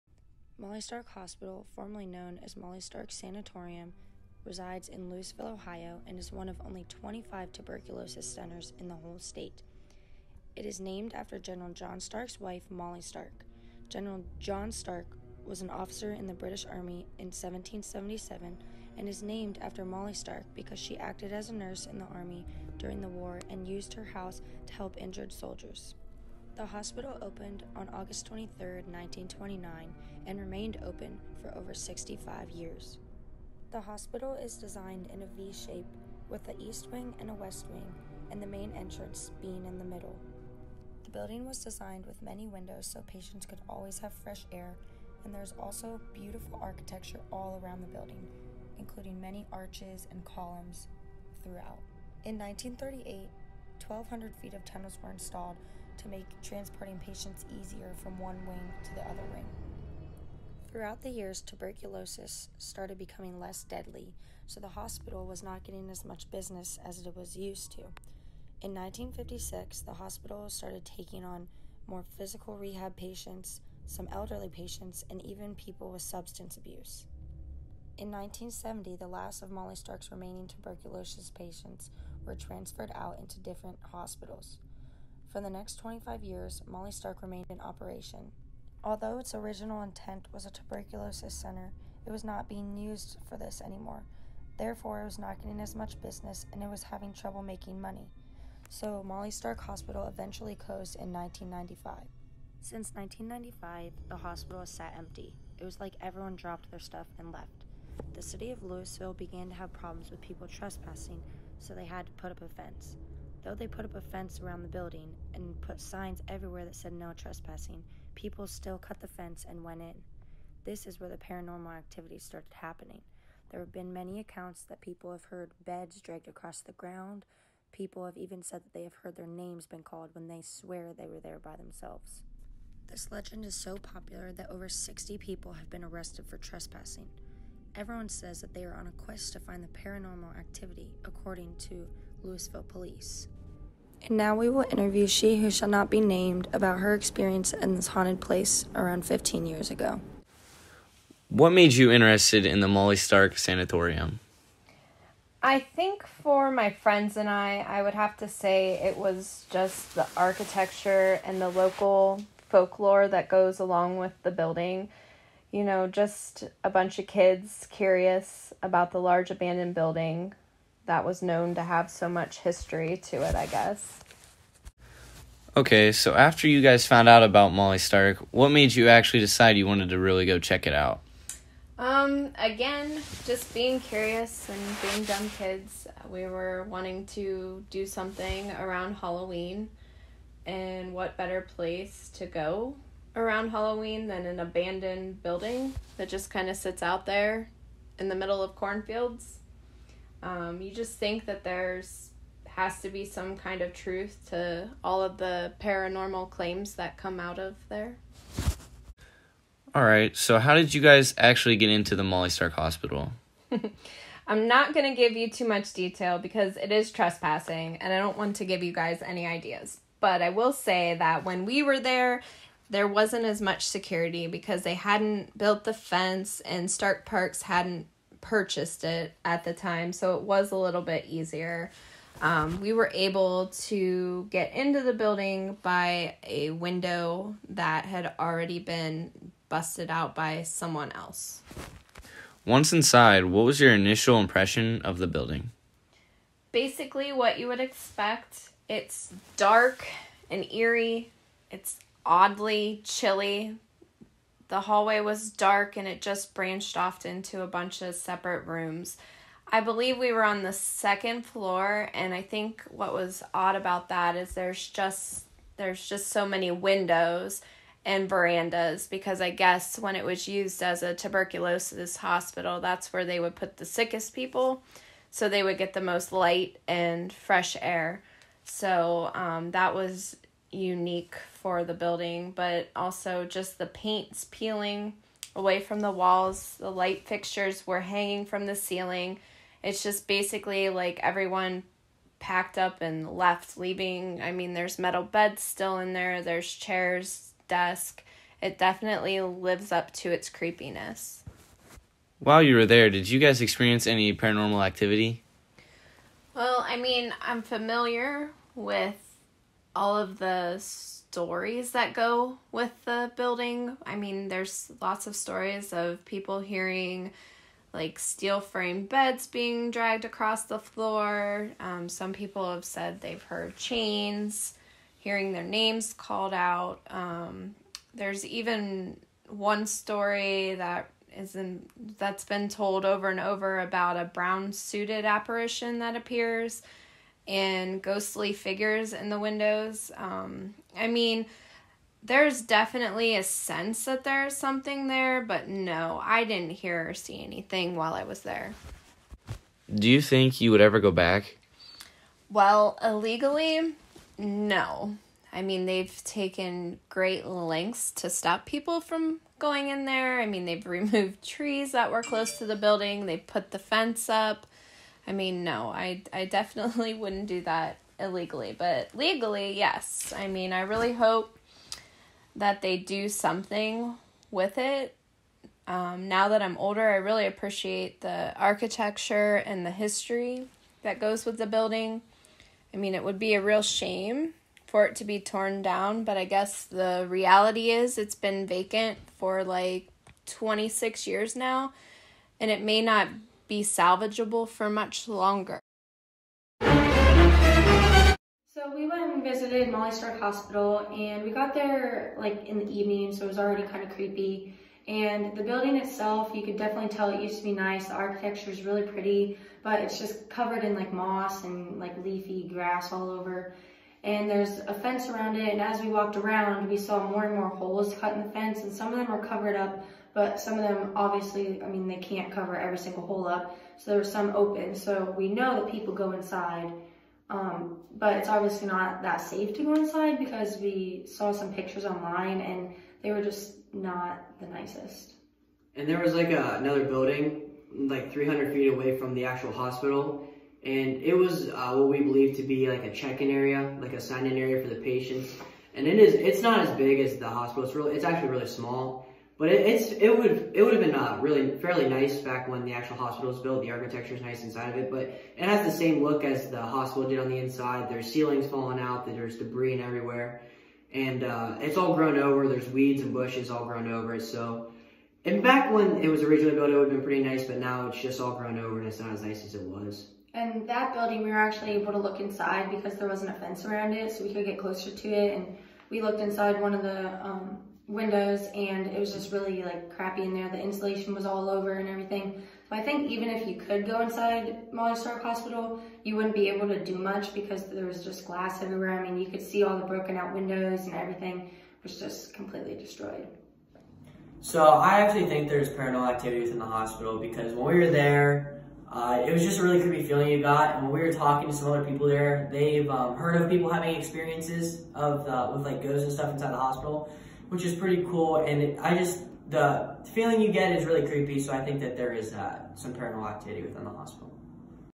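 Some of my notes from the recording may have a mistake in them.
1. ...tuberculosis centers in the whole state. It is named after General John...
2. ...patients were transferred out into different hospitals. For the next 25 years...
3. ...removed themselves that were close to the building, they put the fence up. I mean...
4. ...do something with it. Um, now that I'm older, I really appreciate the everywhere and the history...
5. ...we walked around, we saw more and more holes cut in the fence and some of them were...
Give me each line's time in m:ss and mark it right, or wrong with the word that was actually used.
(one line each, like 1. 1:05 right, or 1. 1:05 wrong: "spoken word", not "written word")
1. 0:07 right
2. 1:21 right
3. 6:00 wrong: "trees", not "themselves"
4. 6:12 wrong: "architecture", not "everywhere"
5. 6:55 right.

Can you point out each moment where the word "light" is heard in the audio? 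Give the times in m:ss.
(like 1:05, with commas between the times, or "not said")
4:36, 4:46.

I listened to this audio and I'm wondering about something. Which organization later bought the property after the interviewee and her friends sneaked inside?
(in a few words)
Stark Parks.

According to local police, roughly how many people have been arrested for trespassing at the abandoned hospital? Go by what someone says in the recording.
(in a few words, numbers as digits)
over 60.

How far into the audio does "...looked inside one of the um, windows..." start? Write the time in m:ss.
7:56.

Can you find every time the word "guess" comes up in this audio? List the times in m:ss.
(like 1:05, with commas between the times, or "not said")
2:53, 4:29, 6:26.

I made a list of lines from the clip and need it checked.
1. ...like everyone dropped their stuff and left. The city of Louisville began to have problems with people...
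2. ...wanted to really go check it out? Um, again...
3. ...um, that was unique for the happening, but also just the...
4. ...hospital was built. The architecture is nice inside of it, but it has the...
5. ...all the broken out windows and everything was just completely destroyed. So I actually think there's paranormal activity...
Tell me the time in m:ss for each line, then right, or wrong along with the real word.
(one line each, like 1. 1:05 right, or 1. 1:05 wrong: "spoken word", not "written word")
1. 1:45 right
2. 2:59 right
3. 4:39 wrong: "building", not "happening"
4. 7:32 right
5. 8:09 right.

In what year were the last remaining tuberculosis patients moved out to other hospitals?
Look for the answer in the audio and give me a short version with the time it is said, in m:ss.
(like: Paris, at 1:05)
1970, at 1:18.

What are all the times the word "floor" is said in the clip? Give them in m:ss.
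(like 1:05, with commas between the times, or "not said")
4:21, 5:20.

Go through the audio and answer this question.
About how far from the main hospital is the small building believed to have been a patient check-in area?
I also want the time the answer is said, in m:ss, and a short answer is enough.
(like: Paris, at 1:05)
300 feet, at 7:18.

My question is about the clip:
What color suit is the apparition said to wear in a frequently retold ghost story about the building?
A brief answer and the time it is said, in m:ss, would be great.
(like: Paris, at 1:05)
Brown, at 5:34.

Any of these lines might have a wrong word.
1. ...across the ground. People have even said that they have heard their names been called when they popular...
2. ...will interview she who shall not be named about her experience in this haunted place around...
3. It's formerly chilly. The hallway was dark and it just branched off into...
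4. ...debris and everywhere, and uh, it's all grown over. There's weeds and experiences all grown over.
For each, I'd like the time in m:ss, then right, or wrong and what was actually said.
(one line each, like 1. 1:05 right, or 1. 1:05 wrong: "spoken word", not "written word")
1. 2:06 wrong: "swear", not "popular"
2. 2:24 right
3. 4:11 wrong: "oddly", not "formerly"
4. 7:39 wrong: "bushes", not "experiences".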